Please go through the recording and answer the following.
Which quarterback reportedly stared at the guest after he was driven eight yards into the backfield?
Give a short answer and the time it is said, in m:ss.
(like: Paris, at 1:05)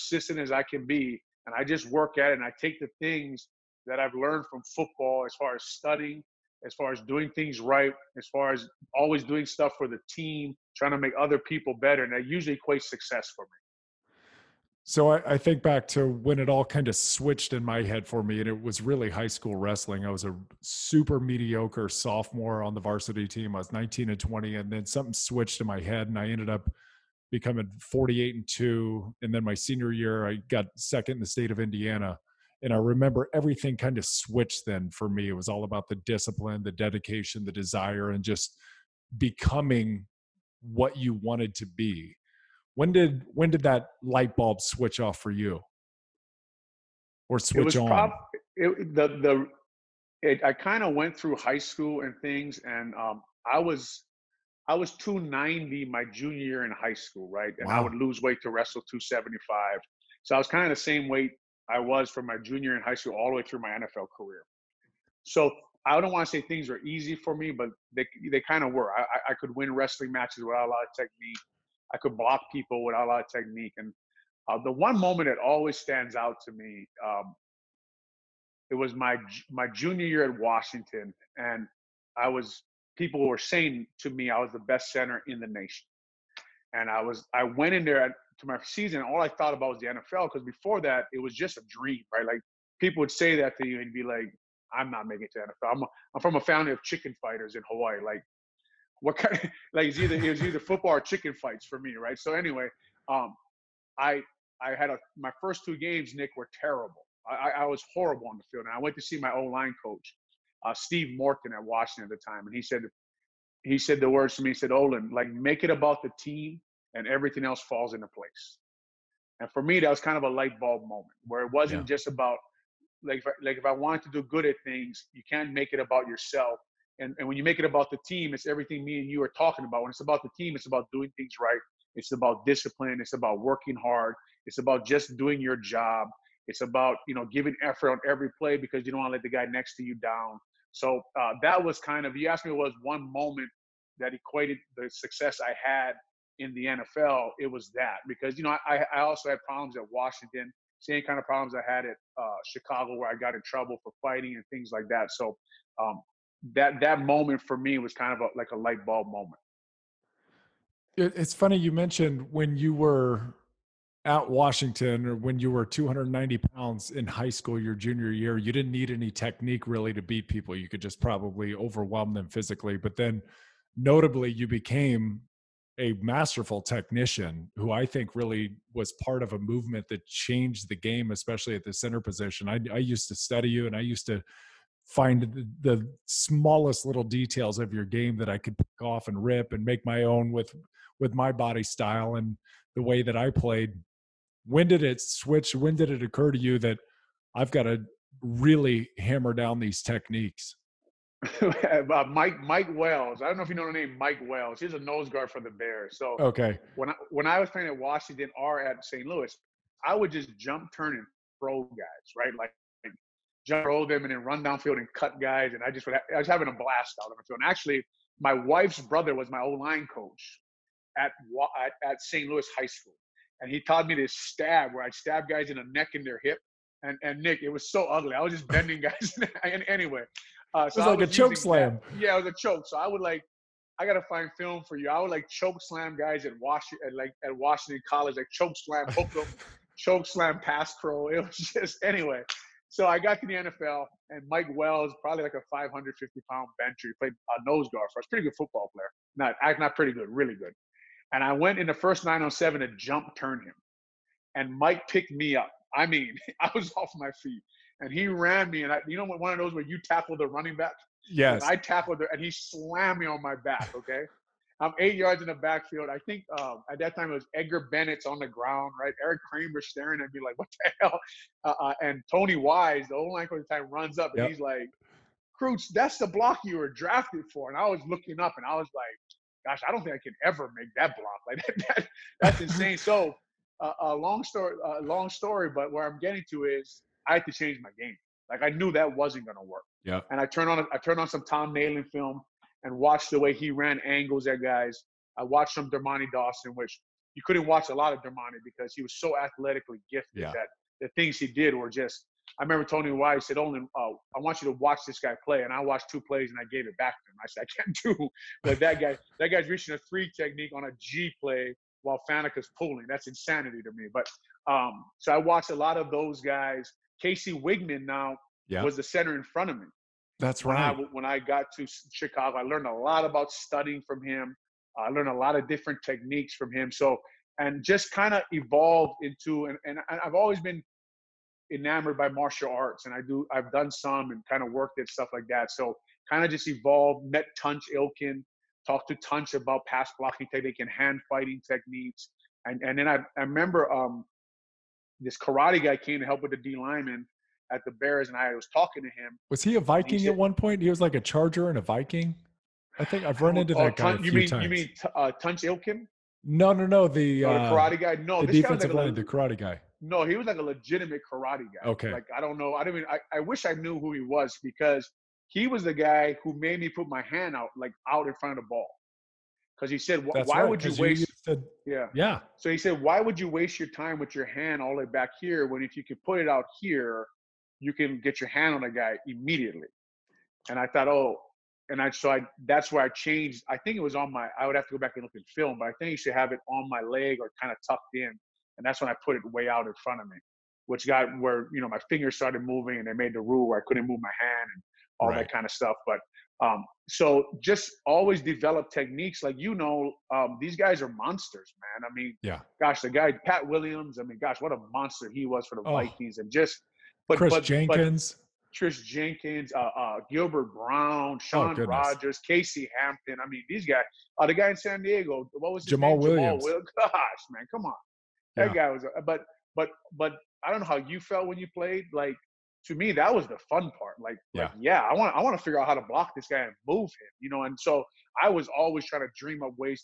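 Eric Kramer, at 4:29.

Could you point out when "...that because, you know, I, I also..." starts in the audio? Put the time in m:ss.
2:27.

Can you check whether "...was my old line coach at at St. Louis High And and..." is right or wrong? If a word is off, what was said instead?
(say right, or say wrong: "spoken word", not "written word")
wrong: "School", not "And".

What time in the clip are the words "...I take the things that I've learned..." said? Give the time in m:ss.
0:02.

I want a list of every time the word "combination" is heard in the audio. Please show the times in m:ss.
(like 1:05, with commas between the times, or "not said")
not said.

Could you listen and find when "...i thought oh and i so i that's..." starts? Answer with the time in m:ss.
6:20.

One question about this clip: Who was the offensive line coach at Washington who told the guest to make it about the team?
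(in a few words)
Steve Morton.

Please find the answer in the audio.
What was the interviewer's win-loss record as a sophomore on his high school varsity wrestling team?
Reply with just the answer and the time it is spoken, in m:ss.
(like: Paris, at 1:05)
19 and 20, at 0:23.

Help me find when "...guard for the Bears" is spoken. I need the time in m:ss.
3:25.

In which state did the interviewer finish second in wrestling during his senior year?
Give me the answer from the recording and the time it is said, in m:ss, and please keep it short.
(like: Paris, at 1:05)
Indiana, at 0:31.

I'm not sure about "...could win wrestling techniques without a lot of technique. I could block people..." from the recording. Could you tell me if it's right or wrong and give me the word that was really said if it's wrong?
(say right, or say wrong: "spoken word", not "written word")
wrong: "matches", not "techniques".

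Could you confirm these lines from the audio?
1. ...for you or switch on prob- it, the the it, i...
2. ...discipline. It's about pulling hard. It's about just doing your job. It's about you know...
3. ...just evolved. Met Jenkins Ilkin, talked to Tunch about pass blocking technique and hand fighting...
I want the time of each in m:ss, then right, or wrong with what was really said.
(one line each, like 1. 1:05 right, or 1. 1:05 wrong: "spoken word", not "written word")
1. 0:45 right
2. 2:12 wrong: "working", not "pulling"
3. 5:36 wrong: "Tunch", not "Jenkins".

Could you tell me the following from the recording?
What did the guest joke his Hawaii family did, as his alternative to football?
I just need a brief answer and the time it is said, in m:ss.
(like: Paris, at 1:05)
Chicken fighters, at 1:36.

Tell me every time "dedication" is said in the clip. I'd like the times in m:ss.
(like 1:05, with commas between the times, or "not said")
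0:36.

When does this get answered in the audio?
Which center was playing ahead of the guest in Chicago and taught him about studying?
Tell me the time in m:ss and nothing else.
5:17.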